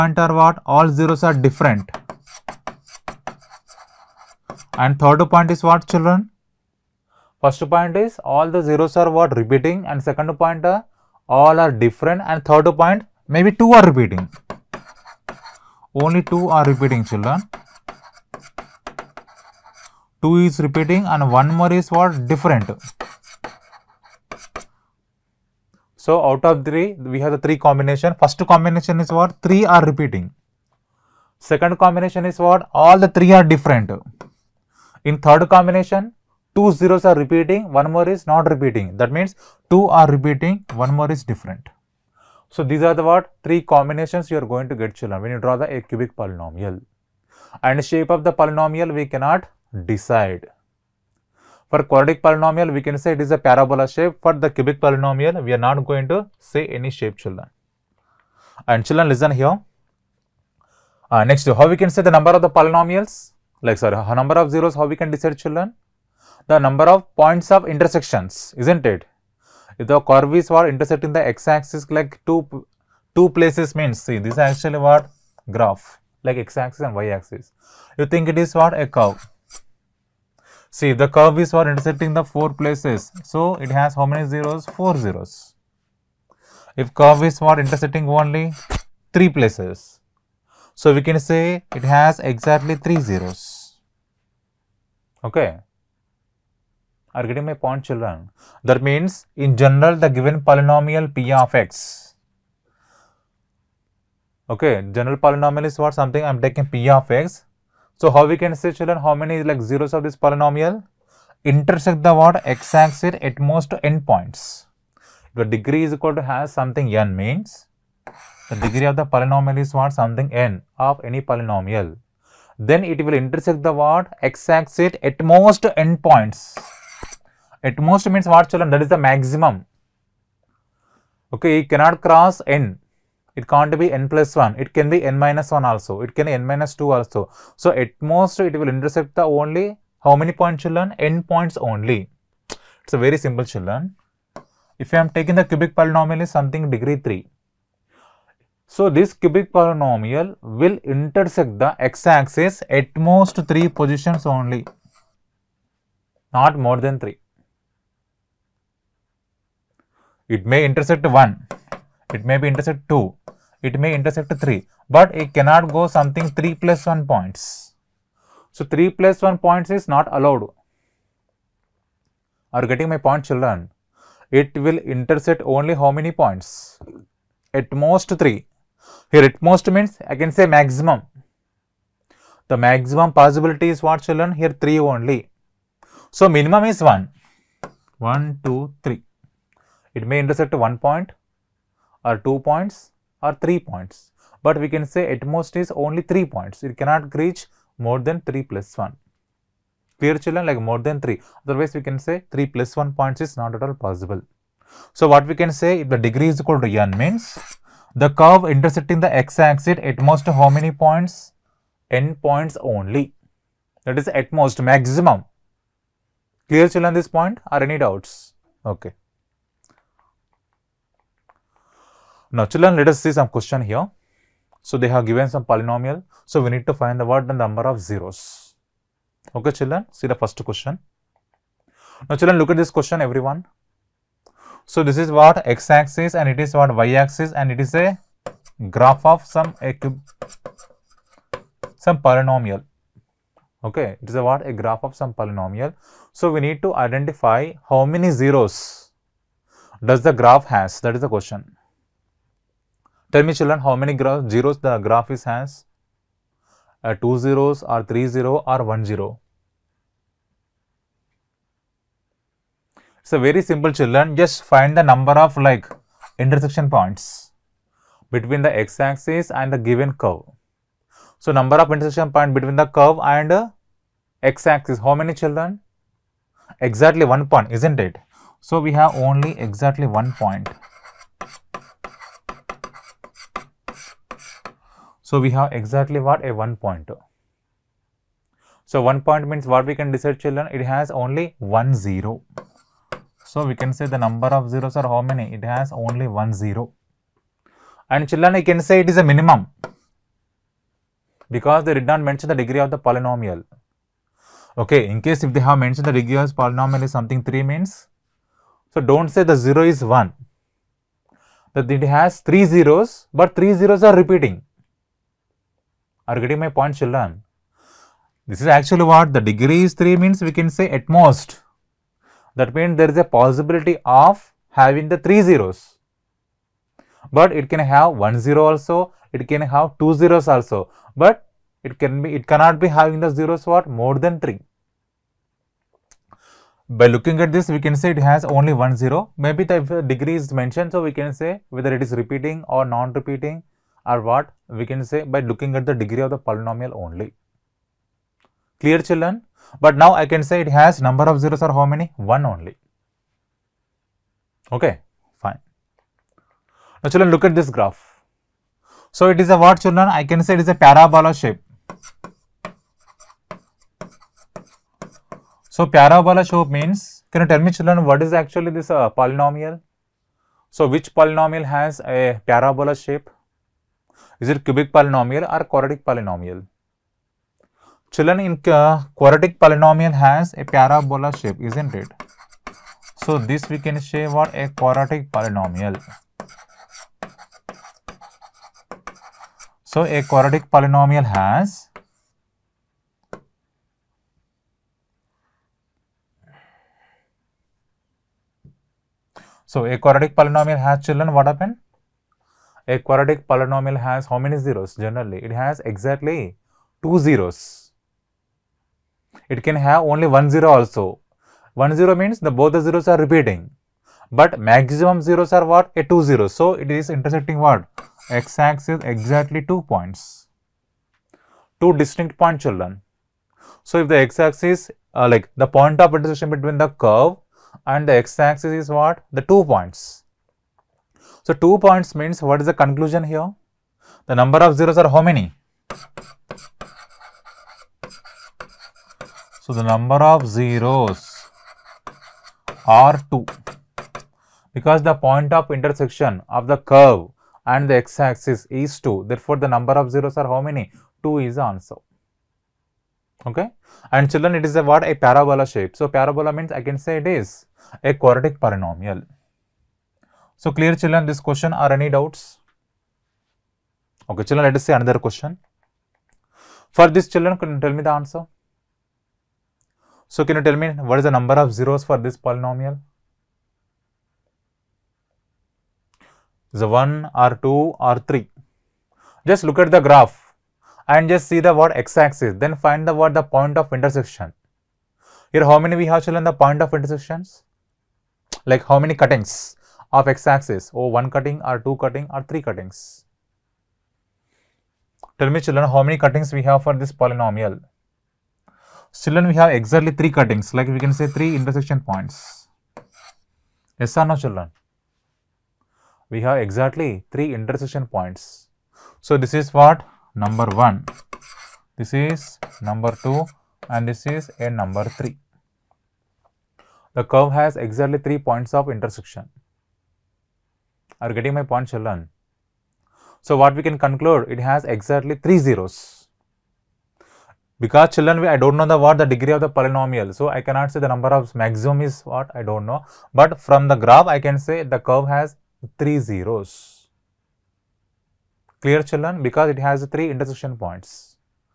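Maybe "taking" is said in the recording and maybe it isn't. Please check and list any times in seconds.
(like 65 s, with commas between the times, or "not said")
106 s, 145 s.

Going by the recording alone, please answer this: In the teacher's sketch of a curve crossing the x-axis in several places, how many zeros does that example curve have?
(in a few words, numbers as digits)
4.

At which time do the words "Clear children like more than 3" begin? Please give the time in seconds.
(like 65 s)
199 s.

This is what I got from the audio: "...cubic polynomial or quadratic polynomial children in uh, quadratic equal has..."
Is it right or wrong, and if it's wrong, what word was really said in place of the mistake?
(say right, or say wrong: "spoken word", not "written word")
wrong: "polynomial", not "equal".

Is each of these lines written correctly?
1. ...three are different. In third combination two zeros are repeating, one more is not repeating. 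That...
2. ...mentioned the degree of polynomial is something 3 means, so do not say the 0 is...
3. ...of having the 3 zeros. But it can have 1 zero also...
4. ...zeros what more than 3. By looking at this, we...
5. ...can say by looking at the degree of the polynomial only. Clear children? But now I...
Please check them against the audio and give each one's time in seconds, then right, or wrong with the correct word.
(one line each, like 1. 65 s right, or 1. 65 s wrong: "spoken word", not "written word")
1. 33 s right
2. 305 s right
3. 323 s right
4. 333 s right
5. 344 s right.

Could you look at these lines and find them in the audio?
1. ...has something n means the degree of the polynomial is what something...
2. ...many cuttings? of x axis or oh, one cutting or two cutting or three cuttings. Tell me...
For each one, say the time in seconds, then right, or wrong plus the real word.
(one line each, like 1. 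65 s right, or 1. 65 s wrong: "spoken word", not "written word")
1. 116 s right
2. 488 s right.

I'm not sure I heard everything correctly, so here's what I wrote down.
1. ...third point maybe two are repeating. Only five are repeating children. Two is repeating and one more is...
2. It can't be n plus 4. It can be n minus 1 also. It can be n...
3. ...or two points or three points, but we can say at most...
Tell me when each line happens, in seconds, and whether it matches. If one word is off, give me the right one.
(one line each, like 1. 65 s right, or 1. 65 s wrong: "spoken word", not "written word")
1. 12 s wrong: "two", not "five"
2. 133 s wrong: "1", not "4"
3. 192 s right.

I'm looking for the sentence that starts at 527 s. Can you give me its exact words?
Because children, I don't know the what the degree of the polynomial.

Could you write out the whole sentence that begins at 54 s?
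For the cubic polynomial we are not going to say any shape children.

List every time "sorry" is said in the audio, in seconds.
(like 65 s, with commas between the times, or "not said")
63 s.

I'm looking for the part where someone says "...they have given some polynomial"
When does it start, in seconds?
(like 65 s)
224 s.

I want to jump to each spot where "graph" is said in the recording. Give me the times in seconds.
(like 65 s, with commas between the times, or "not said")
75 s, 238 s, 244 s, 250 s, 254 s, 357 s, 479 s, 533 s.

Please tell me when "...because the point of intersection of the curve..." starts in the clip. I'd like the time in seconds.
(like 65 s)
444 s.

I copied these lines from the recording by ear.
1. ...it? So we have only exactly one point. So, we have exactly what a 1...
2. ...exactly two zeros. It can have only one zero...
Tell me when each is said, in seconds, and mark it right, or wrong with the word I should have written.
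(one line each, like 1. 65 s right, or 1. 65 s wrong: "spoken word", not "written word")
1. 277 s right
2. 405 s right.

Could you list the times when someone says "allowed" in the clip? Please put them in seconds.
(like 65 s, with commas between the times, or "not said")
170 s.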